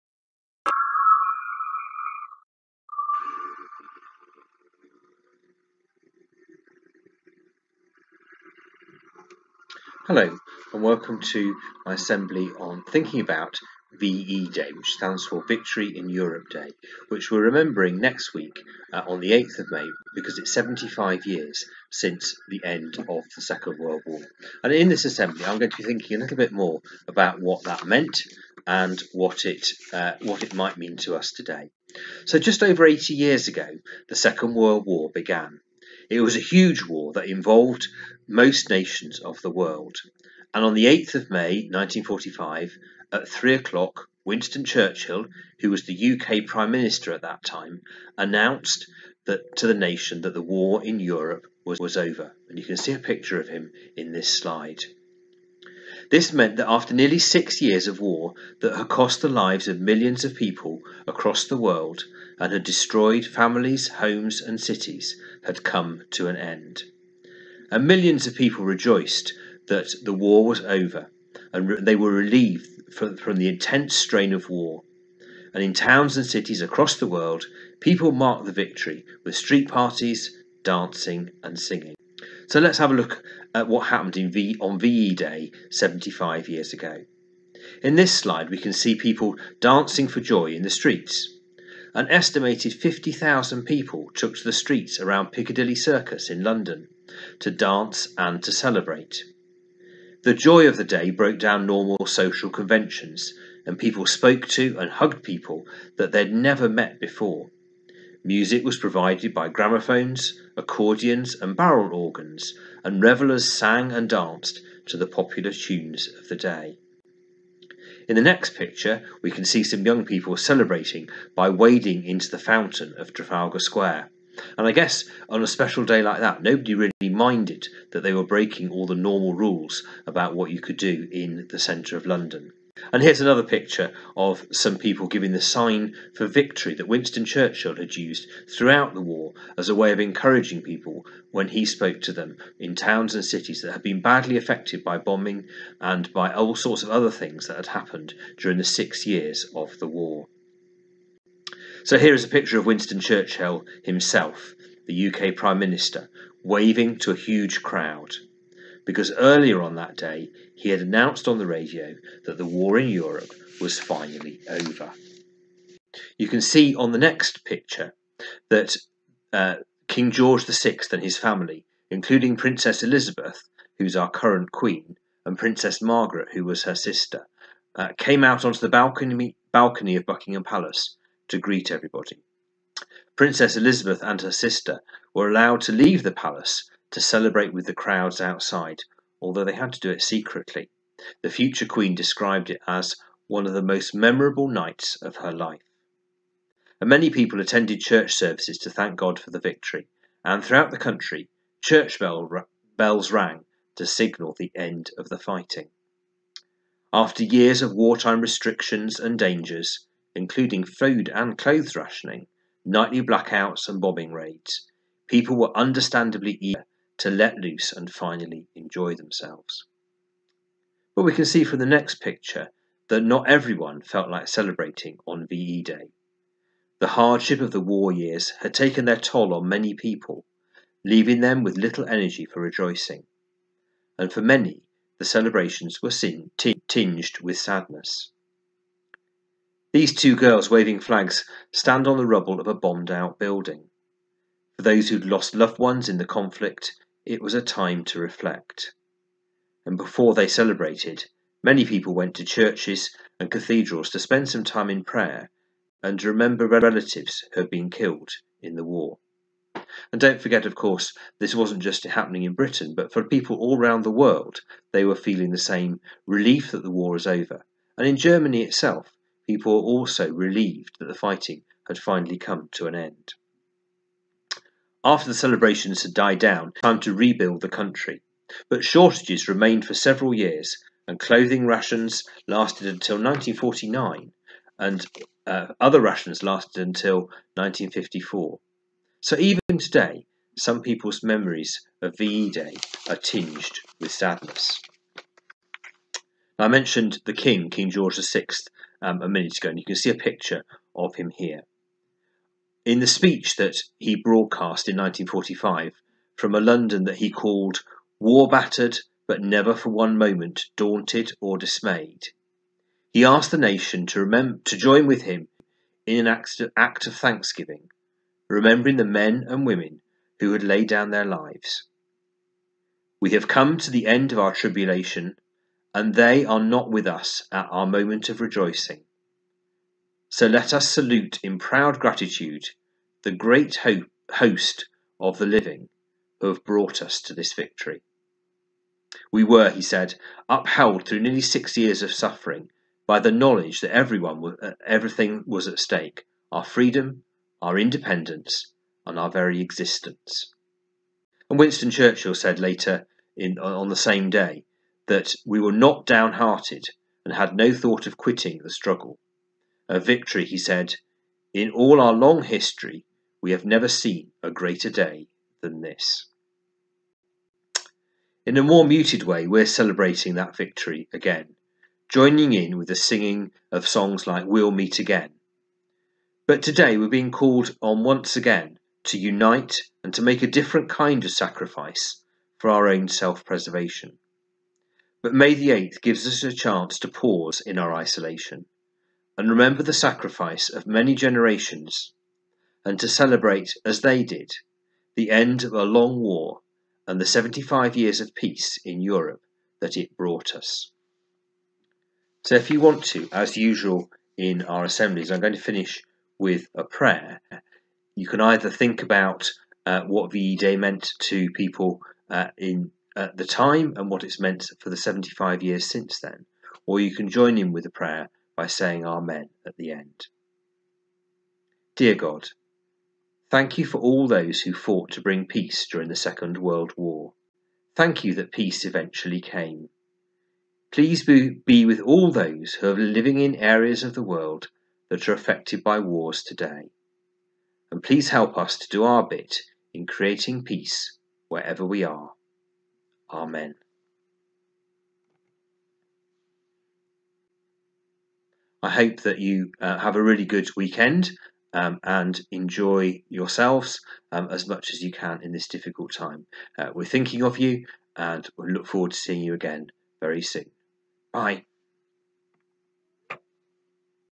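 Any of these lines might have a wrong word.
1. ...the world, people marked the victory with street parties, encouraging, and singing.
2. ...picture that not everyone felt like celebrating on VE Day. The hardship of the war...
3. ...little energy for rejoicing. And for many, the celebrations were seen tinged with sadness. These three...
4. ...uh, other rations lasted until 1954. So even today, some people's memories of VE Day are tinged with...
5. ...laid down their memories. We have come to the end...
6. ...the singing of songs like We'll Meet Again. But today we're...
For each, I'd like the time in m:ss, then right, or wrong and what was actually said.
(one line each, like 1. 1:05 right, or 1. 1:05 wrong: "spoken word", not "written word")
1. 1:16 wrong: "dancing", not "encouraging"
2. 3:41 right
3. 3:51 wrong: "two", not "three"
4. 4:45 right
5. 5:20 wrong: "lives", not "memories"
6. 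6:12 right.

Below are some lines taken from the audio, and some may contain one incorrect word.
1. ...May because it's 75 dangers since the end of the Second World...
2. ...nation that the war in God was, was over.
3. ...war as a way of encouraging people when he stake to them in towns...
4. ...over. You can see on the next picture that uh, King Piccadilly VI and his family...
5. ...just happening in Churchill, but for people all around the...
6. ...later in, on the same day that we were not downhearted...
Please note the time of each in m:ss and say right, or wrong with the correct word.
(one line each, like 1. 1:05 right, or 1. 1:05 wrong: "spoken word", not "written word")
1. 0:19 wrong: "years", not "dangers"
2. 0:49 wrong: "Europe", not "God"
3. 2:19 wrong: "spoke", not "stake"
4. 2:44 wrong: "George", not "Piccadilly"
5. 4:21 wrong: "Britain", not "Churchill"
6. 5:52 right.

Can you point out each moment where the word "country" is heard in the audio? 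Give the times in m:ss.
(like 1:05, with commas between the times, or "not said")
3:20, 4:37.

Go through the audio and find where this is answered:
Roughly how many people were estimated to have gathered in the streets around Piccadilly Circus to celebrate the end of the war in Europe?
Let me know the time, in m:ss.
1:32.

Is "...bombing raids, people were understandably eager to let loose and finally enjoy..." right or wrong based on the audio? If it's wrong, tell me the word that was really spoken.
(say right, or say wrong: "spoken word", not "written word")
right.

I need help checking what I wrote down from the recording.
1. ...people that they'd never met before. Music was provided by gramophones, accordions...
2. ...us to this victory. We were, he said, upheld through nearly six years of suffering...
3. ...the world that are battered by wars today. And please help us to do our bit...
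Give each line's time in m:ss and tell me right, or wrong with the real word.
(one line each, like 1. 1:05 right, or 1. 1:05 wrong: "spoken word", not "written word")
1. 1:45 right
2. 5:36 right
3. 7:13 wrong: "affected", not "battered".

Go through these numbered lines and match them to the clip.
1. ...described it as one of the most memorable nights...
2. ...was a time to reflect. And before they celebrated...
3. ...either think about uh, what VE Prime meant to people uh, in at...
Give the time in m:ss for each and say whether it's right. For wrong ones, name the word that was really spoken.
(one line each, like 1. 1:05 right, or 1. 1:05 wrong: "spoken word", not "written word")
1. 3:11 right
2. 4:07 right
3. 6:48 wrong: "Day", not "Prime".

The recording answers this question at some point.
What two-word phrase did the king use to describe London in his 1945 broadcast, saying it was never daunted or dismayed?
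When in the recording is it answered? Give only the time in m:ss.
5:07.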